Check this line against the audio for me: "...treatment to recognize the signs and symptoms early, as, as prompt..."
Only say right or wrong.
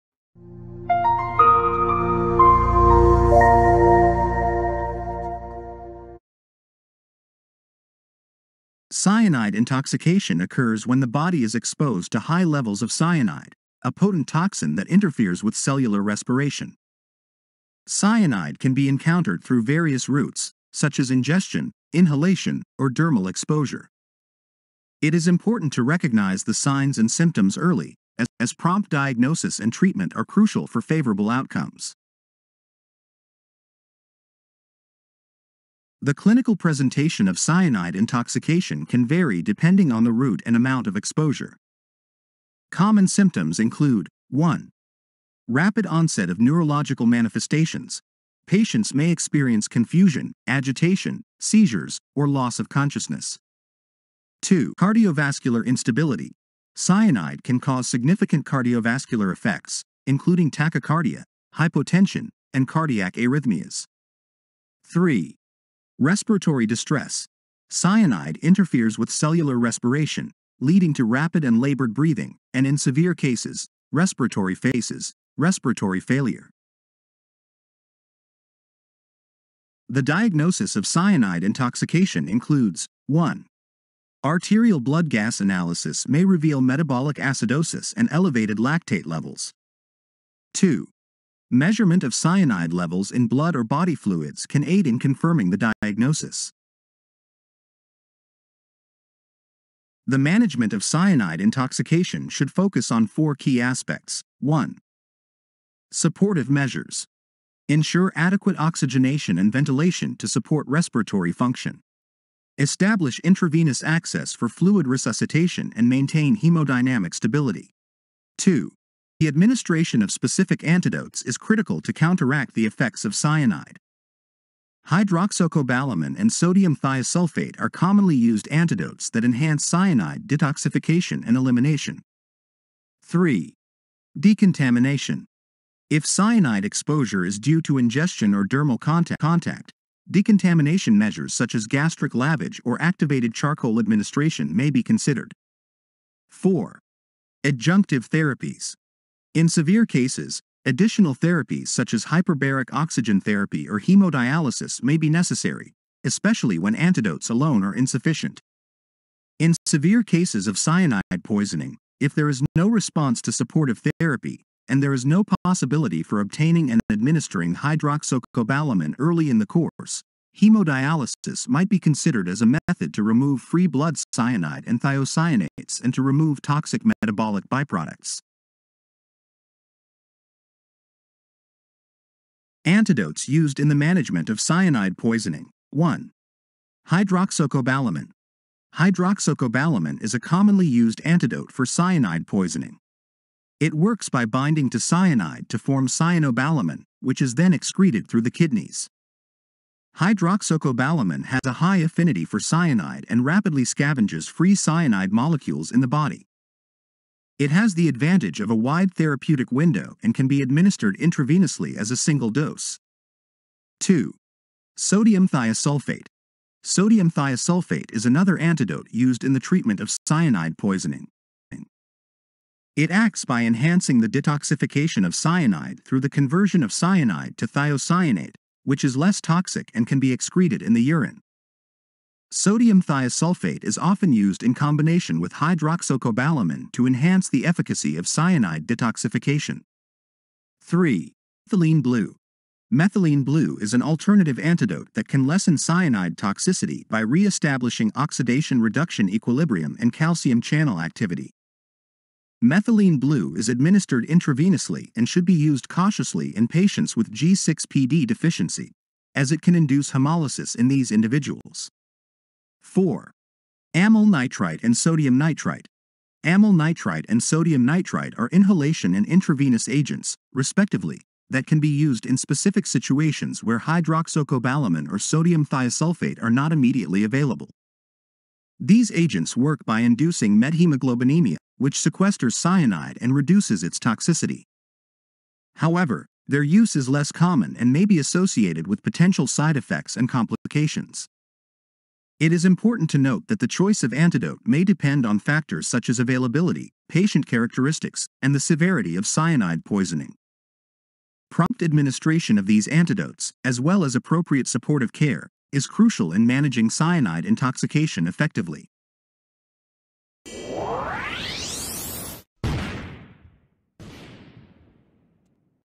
wrong.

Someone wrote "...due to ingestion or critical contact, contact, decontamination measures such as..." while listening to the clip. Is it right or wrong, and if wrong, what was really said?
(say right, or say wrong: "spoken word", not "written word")
wrong: "dermal", not "critical".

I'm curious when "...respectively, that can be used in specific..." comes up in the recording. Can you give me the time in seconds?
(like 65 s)
270 s.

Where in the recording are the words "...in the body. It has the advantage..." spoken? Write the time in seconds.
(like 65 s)
205 s.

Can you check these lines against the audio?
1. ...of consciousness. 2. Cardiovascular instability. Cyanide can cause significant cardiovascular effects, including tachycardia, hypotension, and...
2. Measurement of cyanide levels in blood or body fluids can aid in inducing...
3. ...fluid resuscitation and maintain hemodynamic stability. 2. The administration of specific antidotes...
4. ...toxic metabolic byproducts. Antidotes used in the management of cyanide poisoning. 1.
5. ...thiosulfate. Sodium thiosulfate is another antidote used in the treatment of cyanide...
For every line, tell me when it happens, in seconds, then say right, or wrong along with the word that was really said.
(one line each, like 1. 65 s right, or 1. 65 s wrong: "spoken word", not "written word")
1. 52 s right
2. 91 s wrong: "confirming", not "inducing"
3. 114 s right
4. 176 s right
5. 215 s right.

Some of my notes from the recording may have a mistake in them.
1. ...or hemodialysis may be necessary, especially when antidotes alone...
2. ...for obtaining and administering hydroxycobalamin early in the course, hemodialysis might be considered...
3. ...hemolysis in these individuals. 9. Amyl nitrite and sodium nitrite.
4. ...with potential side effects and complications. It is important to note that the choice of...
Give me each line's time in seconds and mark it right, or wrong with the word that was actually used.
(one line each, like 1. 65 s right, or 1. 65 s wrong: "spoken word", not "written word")
1. 153 s right
2. 166 s right
3. 259 s wrong: "4", not "9"
4. 288 s right.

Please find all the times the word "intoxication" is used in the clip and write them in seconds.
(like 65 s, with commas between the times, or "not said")
9 s, 37 s, 81 s, 101 s, 307 s.